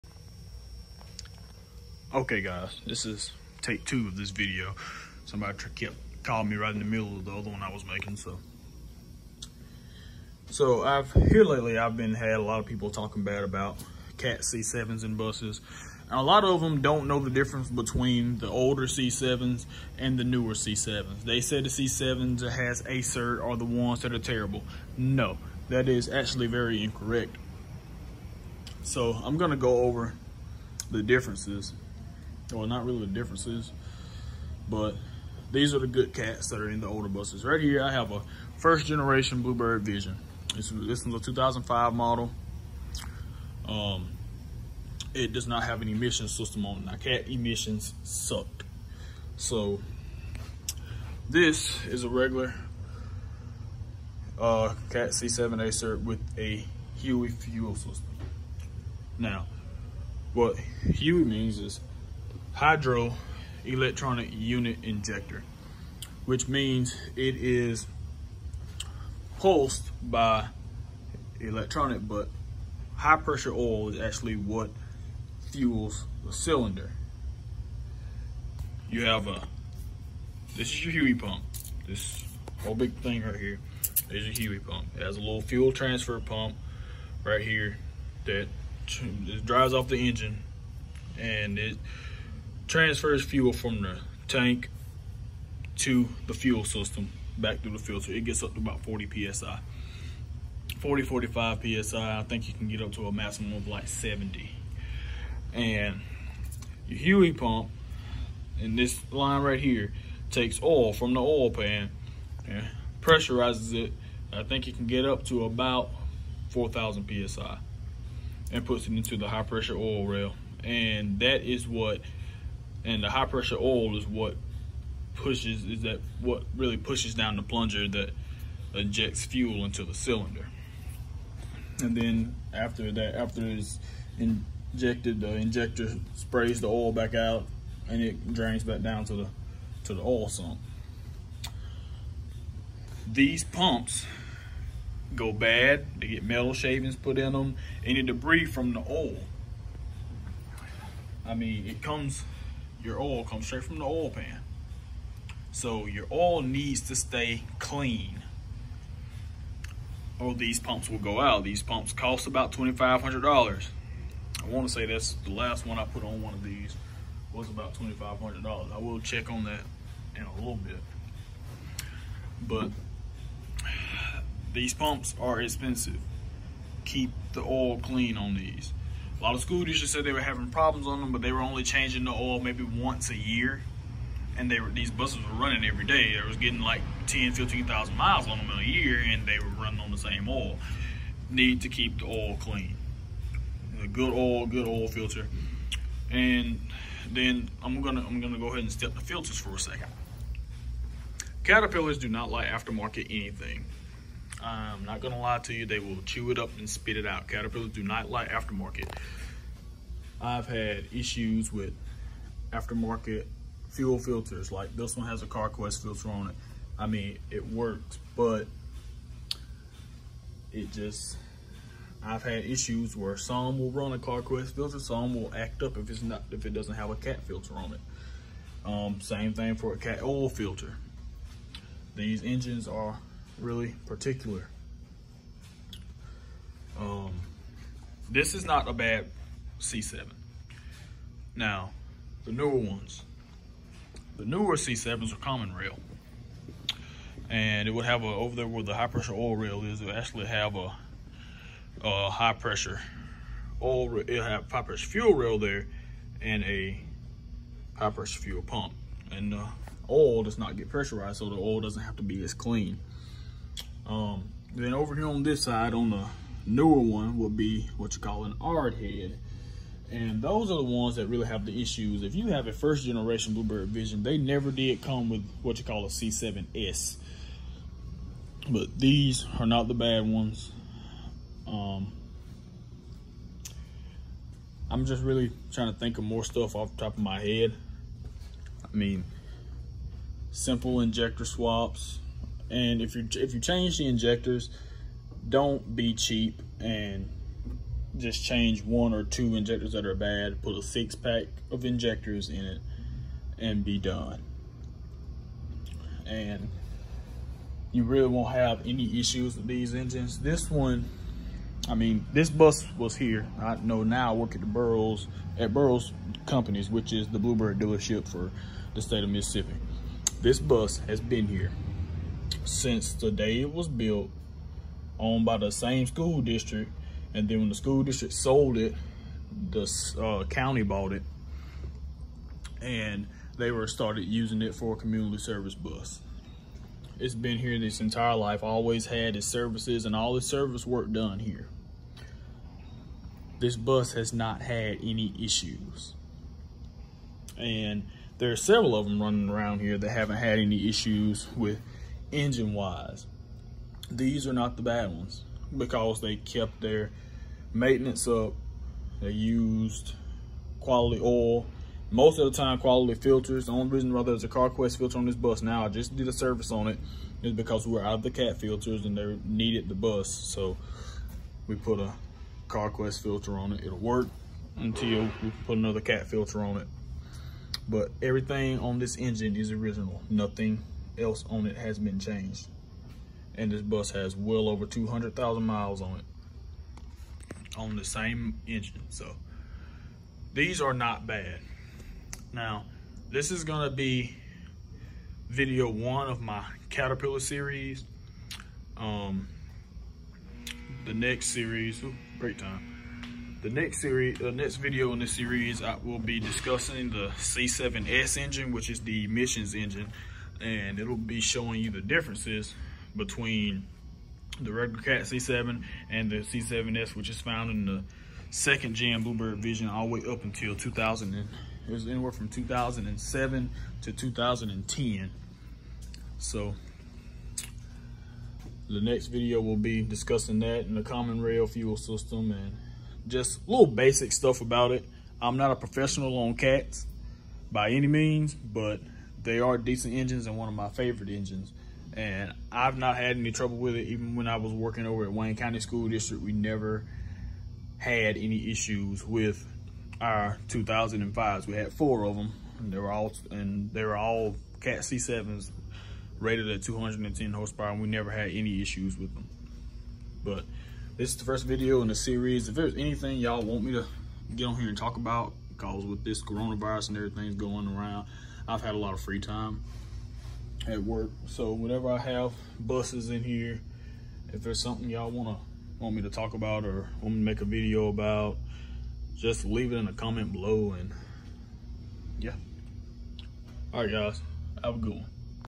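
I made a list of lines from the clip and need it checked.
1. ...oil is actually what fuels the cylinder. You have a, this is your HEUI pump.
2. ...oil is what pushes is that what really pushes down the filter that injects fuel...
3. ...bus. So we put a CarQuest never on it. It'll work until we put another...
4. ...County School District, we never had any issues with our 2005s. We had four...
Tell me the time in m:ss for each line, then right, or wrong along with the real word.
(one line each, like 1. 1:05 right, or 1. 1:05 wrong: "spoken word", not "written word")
1. 1:13 right
2. 2:03 wrong: "plunger", not "filter"
3. 6:09 wrong: "filter", not "never"
4. 7:25 right.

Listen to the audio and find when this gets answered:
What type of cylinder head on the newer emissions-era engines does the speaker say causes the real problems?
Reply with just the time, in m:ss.
4:28.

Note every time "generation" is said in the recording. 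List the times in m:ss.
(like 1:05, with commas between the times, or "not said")
0:38, 4:32.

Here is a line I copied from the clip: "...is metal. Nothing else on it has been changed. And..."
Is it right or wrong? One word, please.
wrong.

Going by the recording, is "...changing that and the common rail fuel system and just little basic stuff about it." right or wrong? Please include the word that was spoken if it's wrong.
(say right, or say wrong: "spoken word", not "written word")
wrong: "discussing", not "changing".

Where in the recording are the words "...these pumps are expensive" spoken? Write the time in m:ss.
2:54.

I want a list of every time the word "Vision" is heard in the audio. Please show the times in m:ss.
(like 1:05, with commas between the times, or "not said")
0:39, 4:33, 6:59.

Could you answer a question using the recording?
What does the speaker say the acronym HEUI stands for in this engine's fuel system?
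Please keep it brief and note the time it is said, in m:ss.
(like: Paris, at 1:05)
Hydro electronic unit injector, at 1:02.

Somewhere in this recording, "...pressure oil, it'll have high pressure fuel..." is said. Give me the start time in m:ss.
4:12.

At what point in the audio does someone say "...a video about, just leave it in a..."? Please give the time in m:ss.
7:57.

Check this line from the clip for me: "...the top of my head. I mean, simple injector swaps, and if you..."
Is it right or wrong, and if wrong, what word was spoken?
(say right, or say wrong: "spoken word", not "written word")
right.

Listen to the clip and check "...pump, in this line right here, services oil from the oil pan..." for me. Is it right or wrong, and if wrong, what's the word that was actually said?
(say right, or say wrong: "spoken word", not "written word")
wrong: "takes", not "services".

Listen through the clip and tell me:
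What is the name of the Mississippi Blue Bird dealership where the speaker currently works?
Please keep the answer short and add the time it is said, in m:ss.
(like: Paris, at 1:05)
Burroughs Companies, at 5:15.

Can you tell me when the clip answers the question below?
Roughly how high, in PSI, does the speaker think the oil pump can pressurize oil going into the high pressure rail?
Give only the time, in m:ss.
1:56.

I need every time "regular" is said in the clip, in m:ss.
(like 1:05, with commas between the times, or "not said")
0:52, 6:54.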